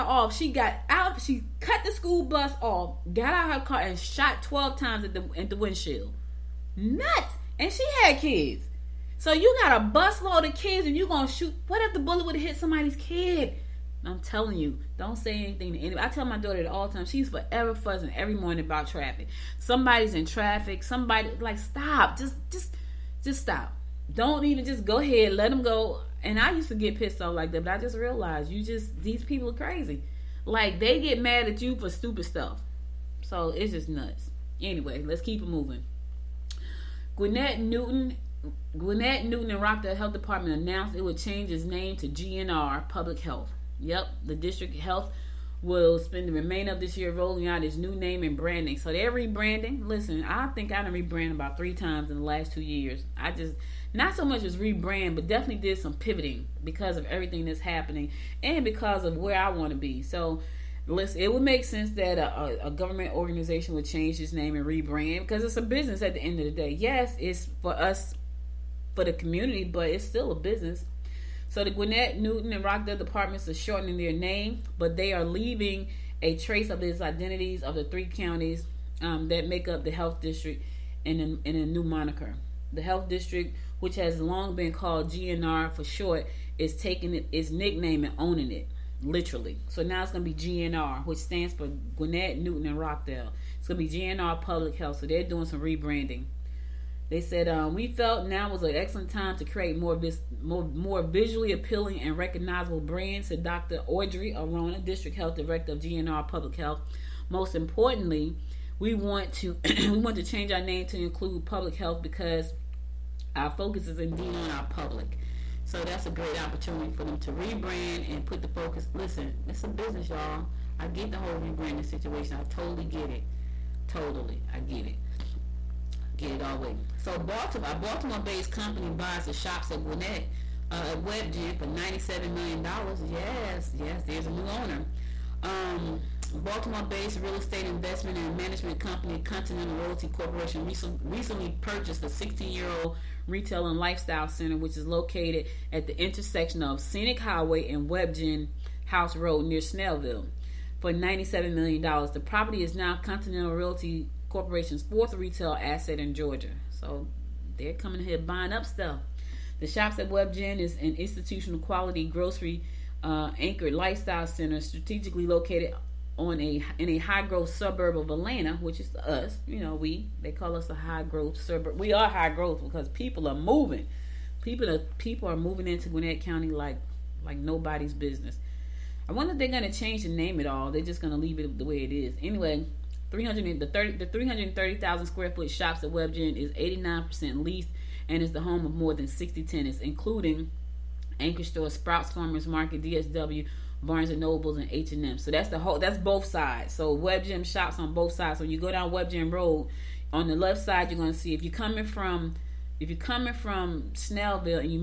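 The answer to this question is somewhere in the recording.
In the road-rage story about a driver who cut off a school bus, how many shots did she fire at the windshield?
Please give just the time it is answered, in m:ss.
0:04.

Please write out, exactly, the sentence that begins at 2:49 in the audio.
You know, we they call us a high growth suburb.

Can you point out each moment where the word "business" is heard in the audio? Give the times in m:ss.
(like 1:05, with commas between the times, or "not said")
1:05, 1:10, 1:59, 2:57.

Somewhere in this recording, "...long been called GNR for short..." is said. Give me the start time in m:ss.
1:24.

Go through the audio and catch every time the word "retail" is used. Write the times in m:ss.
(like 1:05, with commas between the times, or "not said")
2:23, 2:35.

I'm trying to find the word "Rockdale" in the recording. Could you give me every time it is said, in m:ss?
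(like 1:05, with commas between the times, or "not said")
0:39, 1:12, 1:32.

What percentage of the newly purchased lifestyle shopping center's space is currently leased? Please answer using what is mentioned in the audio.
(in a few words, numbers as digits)
89%.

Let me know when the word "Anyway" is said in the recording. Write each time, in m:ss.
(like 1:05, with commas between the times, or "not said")
0:34, 3:02.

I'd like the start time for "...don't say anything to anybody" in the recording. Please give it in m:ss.
0:14.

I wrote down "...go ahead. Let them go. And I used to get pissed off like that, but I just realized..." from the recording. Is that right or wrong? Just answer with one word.
right.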